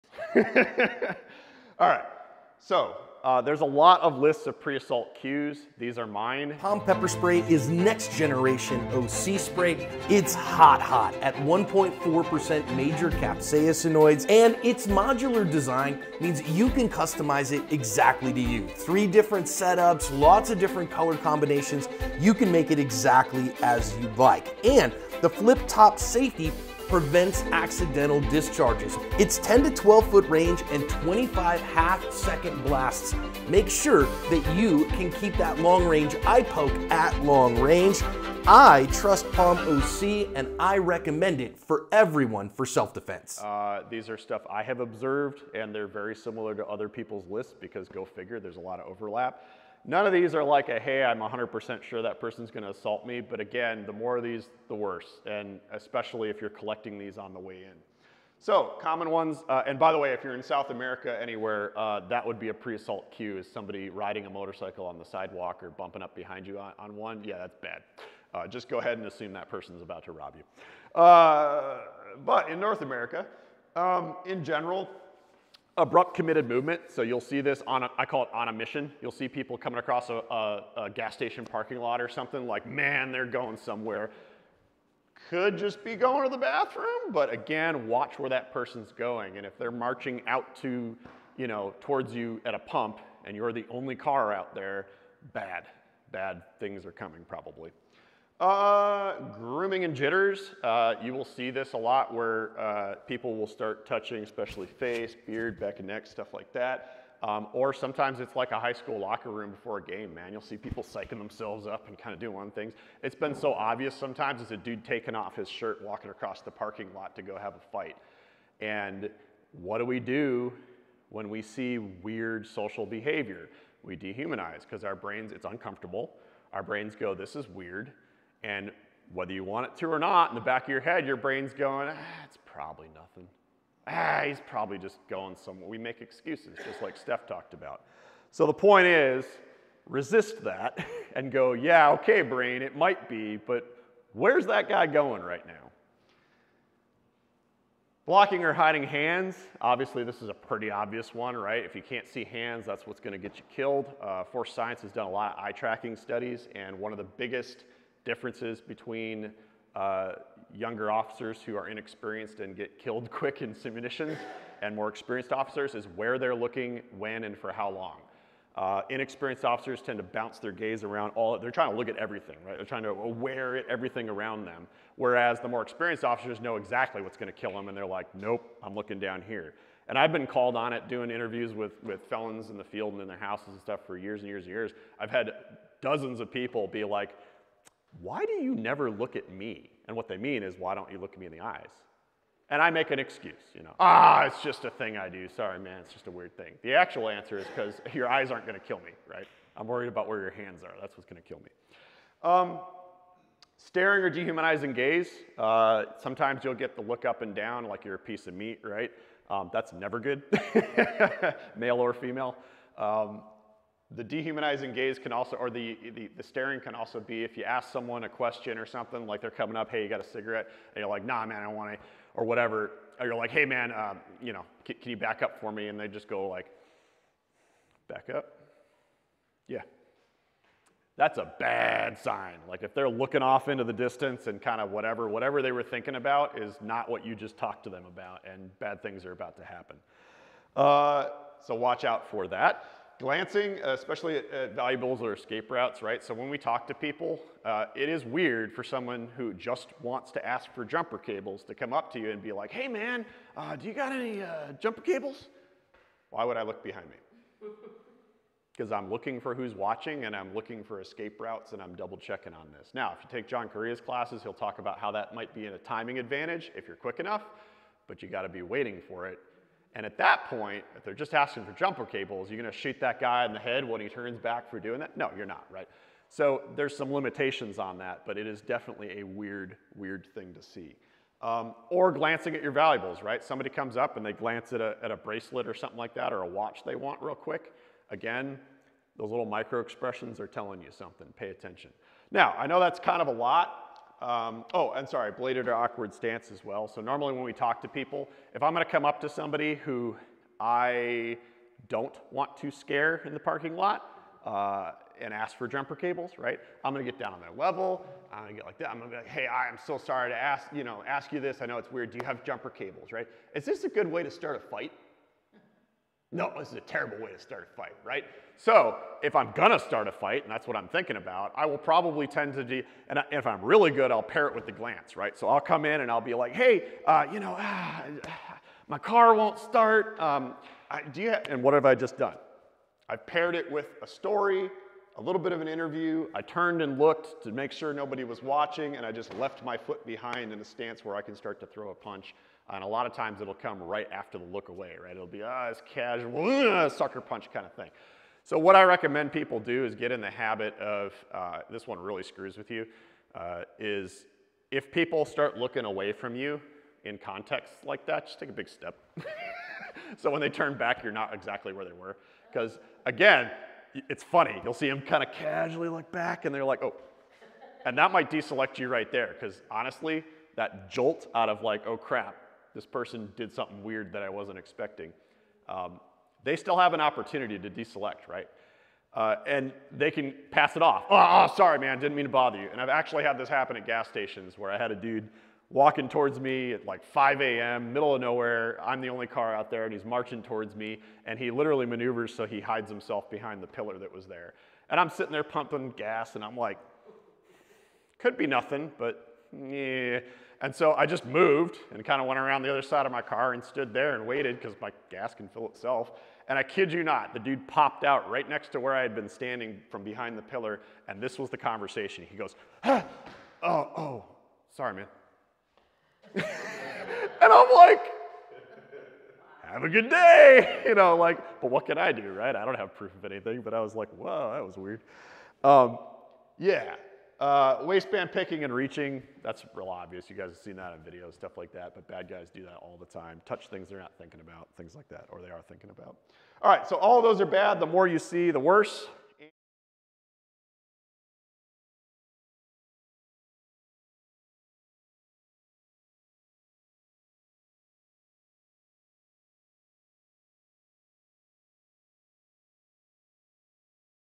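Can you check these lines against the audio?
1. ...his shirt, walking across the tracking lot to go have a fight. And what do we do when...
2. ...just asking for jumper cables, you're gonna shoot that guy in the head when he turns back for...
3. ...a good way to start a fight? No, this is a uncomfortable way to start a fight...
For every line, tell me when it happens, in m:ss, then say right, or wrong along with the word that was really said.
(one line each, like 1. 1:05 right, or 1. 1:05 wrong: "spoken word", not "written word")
1. 1:55 wrong: "parking", not "tracking"
2. 4:30 right
3. 5:13 wrong: "terrible", not "uncomfortable".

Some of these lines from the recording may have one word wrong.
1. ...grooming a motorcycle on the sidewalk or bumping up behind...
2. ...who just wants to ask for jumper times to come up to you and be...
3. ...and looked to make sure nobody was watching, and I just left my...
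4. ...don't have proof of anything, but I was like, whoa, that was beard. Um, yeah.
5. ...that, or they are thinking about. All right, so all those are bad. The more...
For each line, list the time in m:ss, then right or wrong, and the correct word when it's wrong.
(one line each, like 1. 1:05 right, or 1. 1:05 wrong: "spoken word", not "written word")
1. 1:03 wrong: "riding", not "grooming"
2. 4:09 wrong: "cables", not "times"
3. 5:36 right
4. 7:02 wrong: "weird", not "beard"
5. 7:14 right.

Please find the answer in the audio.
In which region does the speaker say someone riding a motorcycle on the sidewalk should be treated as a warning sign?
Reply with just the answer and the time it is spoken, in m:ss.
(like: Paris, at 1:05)
South America, at 1:00.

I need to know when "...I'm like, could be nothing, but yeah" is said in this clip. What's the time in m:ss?
6:36.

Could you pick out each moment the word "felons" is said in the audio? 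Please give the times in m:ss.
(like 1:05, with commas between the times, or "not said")
3:02.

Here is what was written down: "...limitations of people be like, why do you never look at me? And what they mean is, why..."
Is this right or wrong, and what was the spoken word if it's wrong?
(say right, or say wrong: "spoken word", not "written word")
wrong: "dozens", not "limitations".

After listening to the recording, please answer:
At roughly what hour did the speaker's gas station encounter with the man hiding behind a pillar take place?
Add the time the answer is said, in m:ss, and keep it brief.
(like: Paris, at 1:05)
5 a.m., at 6:26.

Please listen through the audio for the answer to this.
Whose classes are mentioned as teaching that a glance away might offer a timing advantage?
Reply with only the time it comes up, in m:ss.
4:23.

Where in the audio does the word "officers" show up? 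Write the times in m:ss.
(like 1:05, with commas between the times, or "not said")
2:40, 2:45, 2:49, 2:56.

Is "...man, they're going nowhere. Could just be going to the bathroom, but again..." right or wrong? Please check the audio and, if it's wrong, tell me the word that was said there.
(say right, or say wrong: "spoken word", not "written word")
wrong: "somewhere", not "nowhere".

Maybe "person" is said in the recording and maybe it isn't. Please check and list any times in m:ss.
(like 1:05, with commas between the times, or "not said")
0:52, 1:09, 1:28, 6:12.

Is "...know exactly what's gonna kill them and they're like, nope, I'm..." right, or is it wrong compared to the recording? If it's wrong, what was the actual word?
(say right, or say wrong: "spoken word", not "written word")
right.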